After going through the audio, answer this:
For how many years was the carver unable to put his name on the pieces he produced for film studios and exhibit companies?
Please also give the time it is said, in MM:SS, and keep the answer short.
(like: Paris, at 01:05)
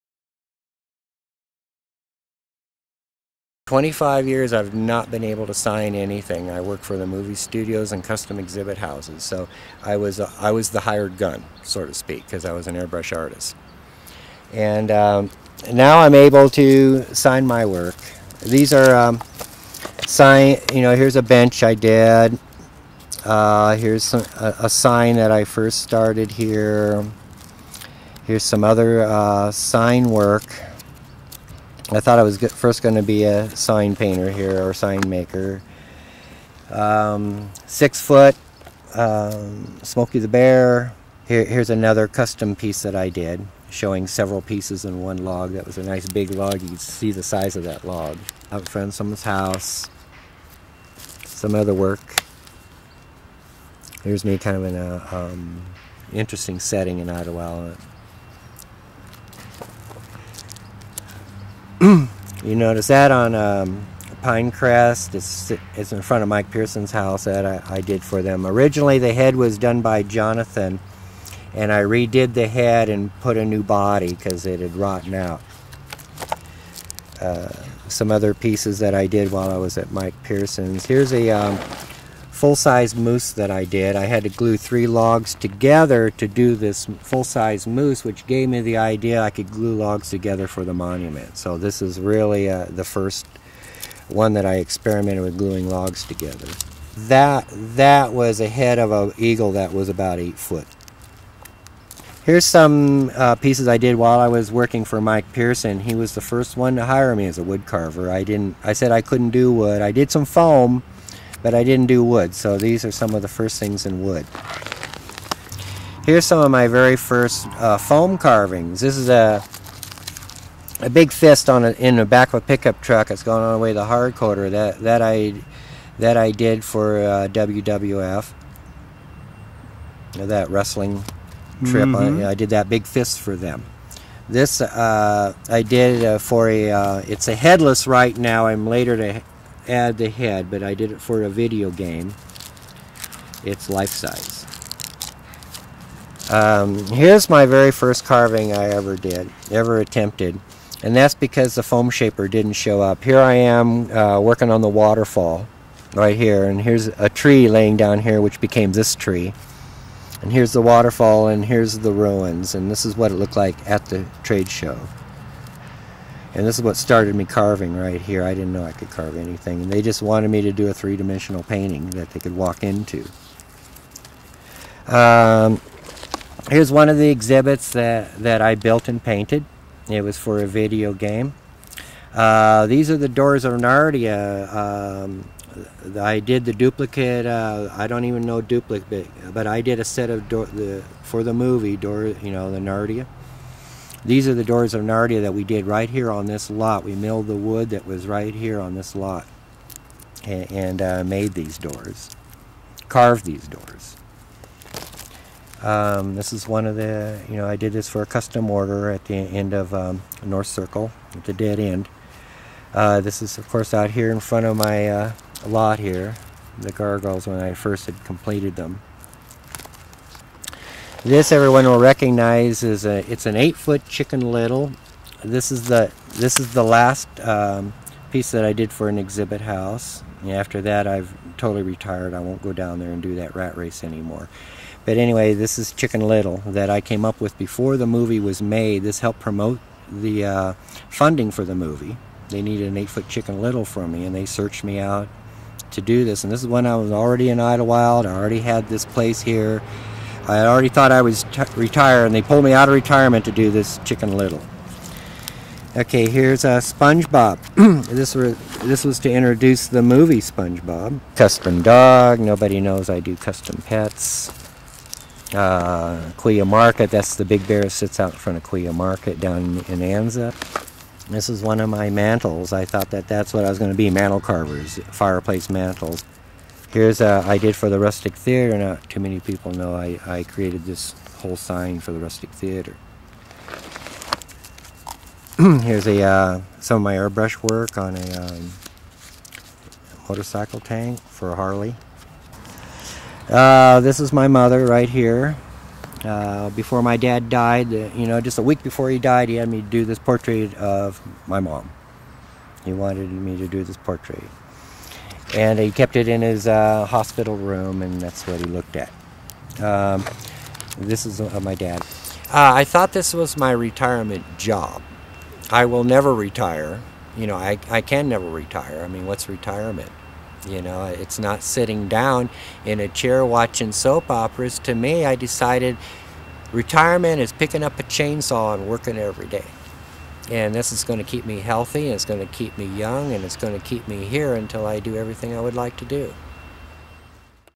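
25, at 00:03.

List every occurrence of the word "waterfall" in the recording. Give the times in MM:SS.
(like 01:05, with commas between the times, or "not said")
02:34, 02:40.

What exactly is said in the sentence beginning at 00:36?
Um, six foot, um, Smokey the Bear.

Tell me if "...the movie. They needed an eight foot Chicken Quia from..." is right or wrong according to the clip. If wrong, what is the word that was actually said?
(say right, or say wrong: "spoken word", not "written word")
wrong: "Little", not "Quia".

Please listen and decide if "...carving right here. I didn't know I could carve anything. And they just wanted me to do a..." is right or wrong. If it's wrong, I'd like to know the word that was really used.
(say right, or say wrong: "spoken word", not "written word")
right.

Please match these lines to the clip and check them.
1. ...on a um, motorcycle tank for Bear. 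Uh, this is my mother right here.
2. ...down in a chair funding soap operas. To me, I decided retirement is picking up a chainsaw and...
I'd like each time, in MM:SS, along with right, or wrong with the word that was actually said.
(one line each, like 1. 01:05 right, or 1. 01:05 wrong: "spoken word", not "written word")
1. 04:47 wrong: "Harley", not "Bear"
2. 05:21 wrong: "watching", not "funding".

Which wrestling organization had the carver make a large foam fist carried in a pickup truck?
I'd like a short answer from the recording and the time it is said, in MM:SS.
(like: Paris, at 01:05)
WWF, at 02:07.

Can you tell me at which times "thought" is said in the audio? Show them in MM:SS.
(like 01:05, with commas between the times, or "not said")
00:31, 04:10, 04:32, 05:12.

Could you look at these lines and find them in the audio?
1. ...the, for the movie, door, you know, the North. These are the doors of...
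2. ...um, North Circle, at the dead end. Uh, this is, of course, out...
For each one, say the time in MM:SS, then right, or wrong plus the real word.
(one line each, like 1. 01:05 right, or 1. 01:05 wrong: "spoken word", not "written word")
1. 03:10 wrong: "Narnia", not "North"
2. 03:29 right.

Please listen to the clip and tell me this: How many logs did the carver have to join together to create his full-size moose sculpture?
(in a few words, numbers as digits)
3.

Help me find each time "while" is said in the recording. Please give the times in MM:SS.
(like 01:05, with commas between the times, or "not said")
01:19, 01:43.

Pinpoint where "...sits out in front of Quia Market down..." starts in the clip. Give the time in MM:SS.
04:27.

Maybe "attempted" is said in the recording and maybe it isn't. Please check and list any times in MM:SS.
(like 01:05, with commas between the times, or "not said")
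02:29.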